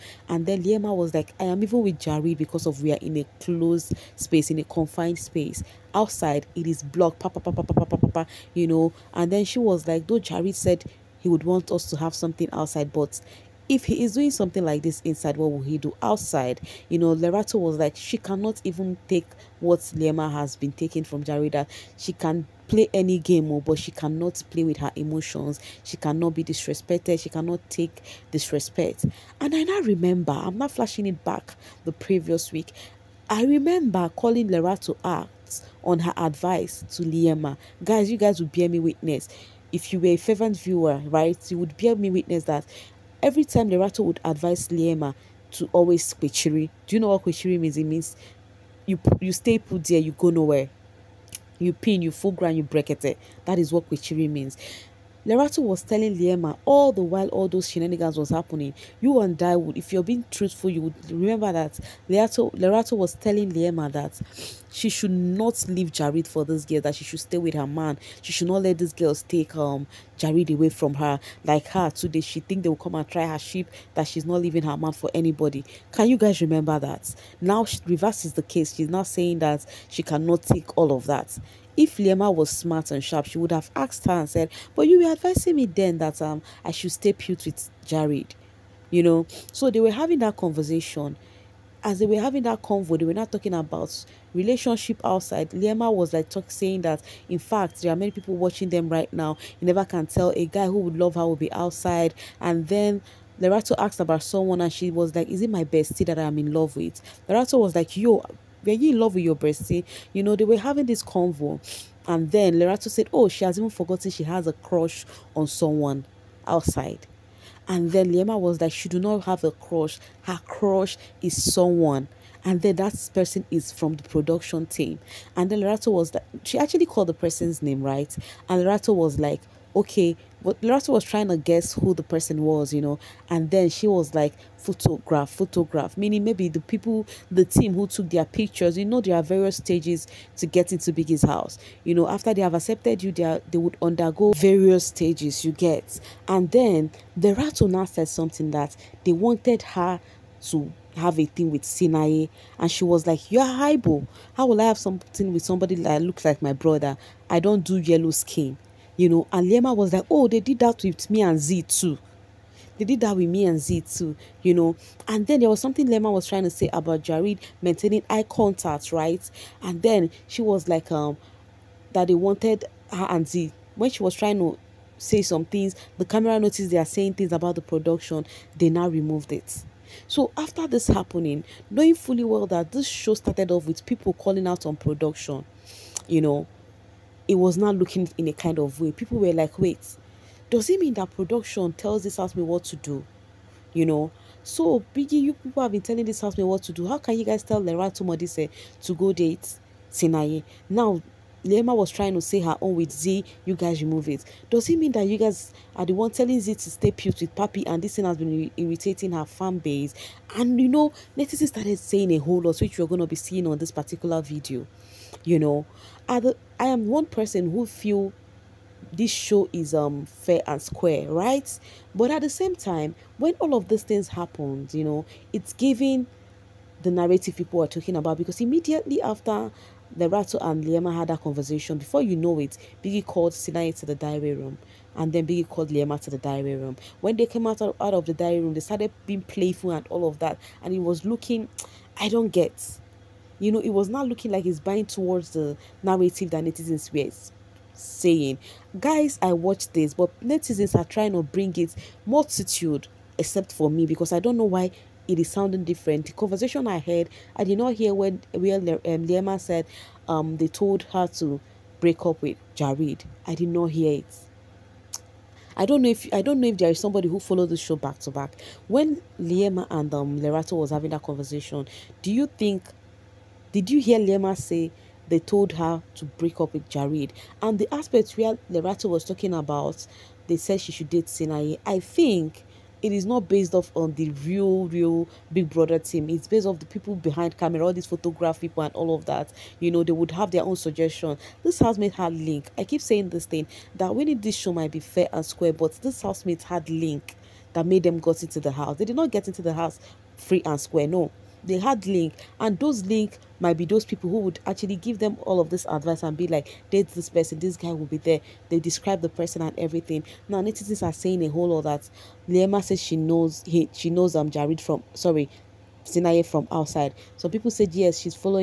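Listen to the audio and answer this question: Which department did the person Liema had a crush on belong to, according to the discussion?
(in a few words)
production team.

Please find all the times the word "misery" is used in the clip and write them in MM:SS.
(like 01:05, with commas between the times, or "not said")
not said.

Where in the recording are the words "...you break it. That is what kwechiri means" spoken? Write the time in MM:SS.
00:52.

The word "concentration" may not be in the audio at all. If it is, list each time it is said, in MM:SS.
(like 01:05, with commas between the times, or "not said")
not said.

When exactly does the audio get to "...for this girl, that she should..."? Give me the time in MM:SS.
01:06.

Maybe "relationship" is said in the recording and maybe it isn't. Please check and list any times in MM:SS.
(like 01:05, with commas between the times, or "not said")
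01:34.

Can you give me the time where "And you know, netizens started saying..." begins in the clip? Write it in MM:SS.
03:30.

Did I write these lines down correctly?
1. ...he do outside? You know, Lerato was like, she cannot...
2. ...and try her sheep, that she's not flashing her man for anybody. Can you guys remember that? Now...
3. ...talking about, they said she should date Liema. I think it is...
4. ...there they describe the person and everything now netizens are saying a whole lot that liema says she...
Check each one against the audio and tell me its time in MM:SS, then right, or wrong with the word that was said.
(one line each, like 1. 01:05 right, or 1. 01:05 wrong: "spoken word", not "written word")
1. 00:15 right
2. 01:12 wrong: "leaving", not "flashing"
3. 04:39 wrong: "Sinaye", not "Liema"
4. 05:07 right.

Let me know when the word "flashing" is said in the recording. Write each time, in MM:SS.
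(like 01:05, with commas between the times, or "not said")
00:30.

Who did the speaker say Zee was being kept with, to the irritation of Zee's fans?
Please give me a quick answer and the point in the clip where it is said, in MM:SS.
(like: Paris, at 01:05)
Papi, at 03:27.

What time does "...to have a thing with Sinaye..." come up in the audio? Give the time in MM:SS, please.
02:30.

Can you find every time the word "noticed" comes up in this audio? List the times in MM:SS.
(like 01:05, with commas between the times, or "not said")
02:56.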